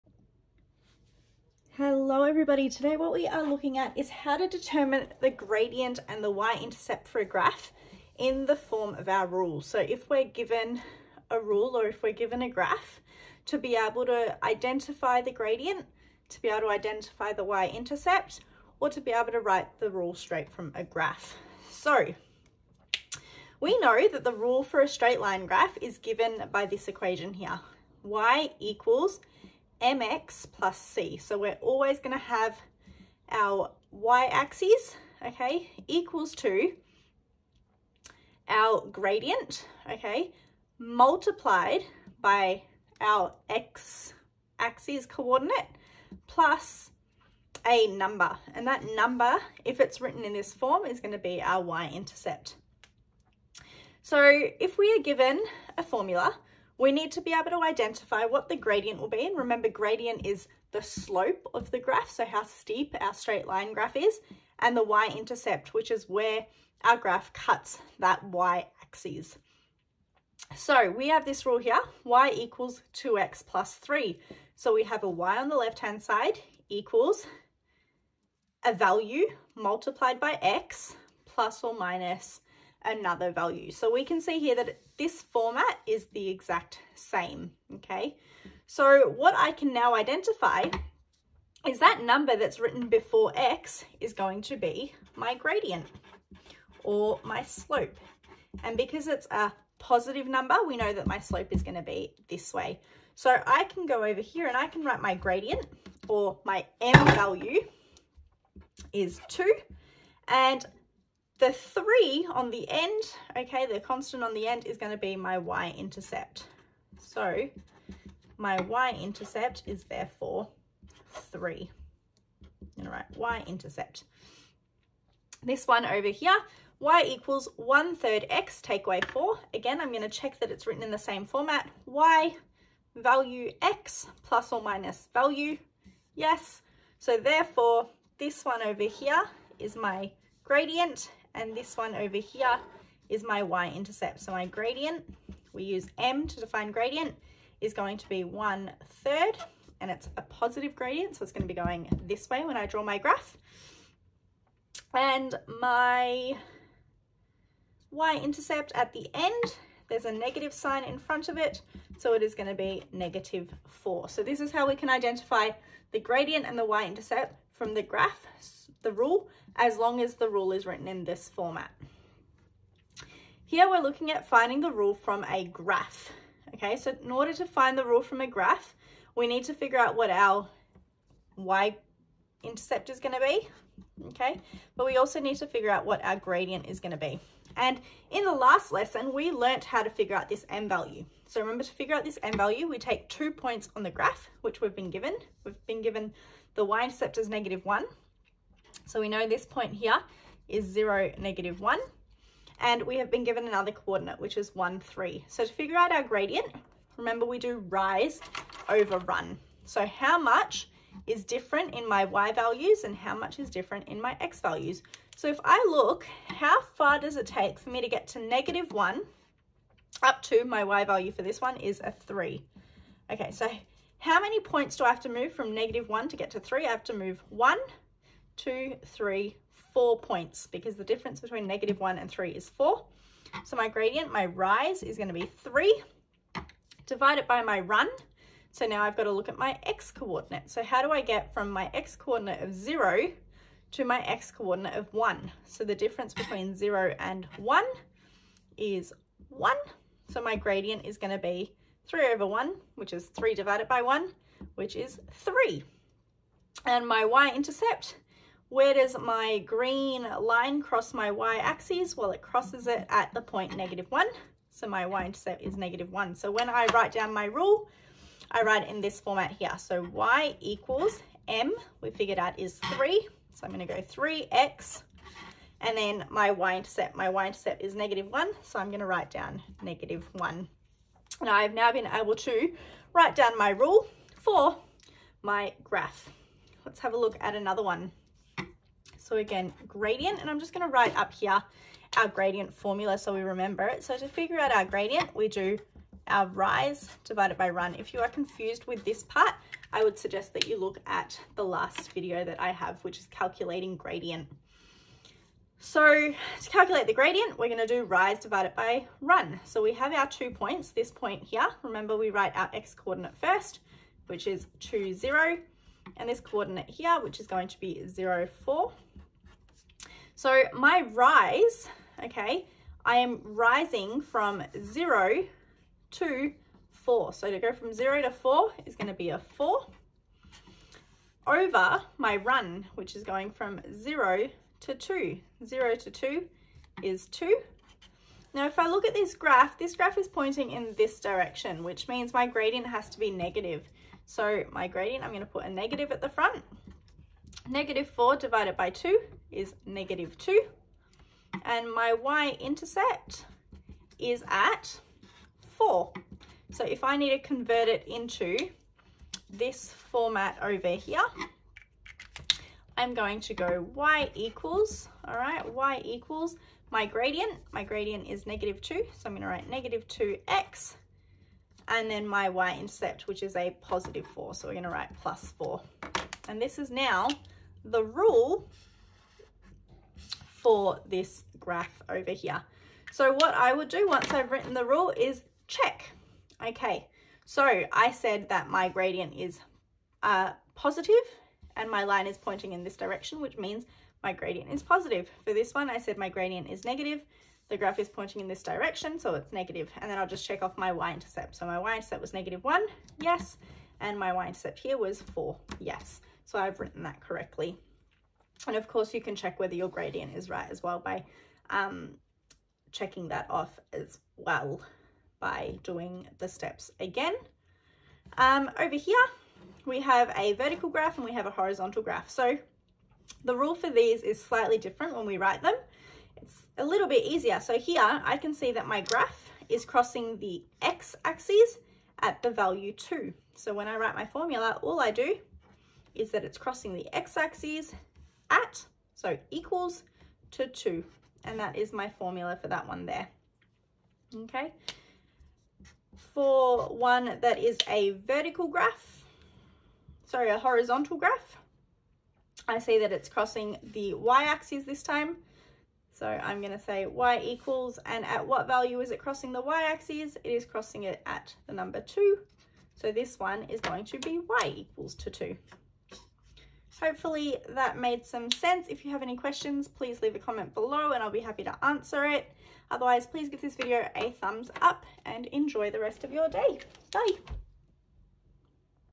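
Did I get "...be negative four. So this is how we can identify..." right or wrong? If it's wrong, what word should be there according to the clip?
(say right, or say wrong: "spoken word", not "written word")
right.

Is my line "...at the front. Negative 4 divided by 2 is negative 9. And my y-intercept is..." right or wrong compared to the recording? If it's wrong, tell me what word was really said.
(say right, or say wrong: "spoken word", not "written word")
wrong: "2", not "9".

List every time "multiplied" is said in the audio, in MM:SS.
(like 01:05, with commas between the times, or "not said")
00:40, 01:19.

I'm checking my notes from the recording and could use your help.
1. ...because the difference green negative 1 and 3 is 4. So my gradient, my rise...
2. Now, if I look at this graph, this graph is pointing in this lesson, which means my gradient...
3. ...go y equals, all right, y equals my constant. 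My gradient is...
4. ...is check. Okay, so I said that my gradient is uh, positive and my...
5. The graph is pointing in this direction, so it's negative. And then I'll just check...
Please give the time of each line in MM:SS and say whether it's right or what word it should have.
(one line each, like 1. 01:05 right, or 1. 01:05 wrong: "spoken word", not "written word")
1. 03:50 wrong: "between", not "green"
2. 05:38 wrong: "direction", not "lesson"
3. 06:03 wrong: "gradient", not "constant"
4. 06:24 right
5. 06:37 right.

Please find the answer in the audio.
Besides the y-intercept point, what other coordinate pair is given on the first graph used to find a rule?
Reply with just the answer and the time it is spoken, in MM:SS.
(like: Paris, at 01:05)
(1, 3), at 03:24.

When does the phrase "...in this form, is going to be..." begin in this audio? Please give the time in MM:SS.
00:50.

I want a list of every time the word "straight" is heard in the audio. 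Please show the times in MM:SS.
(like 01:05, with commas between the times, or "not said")
00:20, 00:24, 01:03.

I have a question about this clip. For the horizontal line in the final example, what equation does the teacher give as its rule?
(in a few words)
y = 2.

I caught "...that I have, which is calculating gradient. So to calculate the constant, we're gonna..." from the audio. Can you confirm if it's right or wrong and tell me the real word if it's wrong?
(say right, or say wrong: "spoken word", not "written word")
wrong: "gradient", not "constant".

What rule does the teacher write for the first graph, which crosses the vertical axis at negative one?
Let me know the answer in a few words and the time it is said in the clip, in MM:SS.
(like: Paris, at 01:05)
y = 3x - 1, at 04:33.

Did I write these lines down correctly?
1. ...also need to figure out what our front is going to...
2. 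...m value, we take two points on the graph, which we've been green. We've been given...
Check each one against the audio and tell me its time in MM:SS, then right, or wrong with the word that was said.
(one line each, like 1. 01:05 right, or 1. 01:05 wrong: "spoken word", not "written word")
1. 03:04 wrong: "gradient", not "front"
2. 03:12 wrong: "given", not "green".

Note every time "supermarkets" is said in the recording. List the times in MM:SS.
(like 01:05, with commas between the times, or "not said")
not said.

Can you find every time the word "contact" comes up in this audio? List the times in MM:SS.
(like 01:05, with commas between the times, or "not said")
not said.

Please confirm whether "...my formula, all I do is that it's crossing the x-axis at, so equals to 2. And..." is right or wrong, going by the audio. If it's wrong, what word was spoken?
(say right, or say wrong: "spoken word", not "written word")
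right.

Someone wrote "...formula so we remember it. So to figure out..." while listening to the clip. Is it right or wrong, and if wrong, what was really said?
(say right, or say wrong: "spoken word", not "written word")
right.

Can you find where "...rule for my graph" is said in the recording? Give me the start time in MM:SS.
04:43.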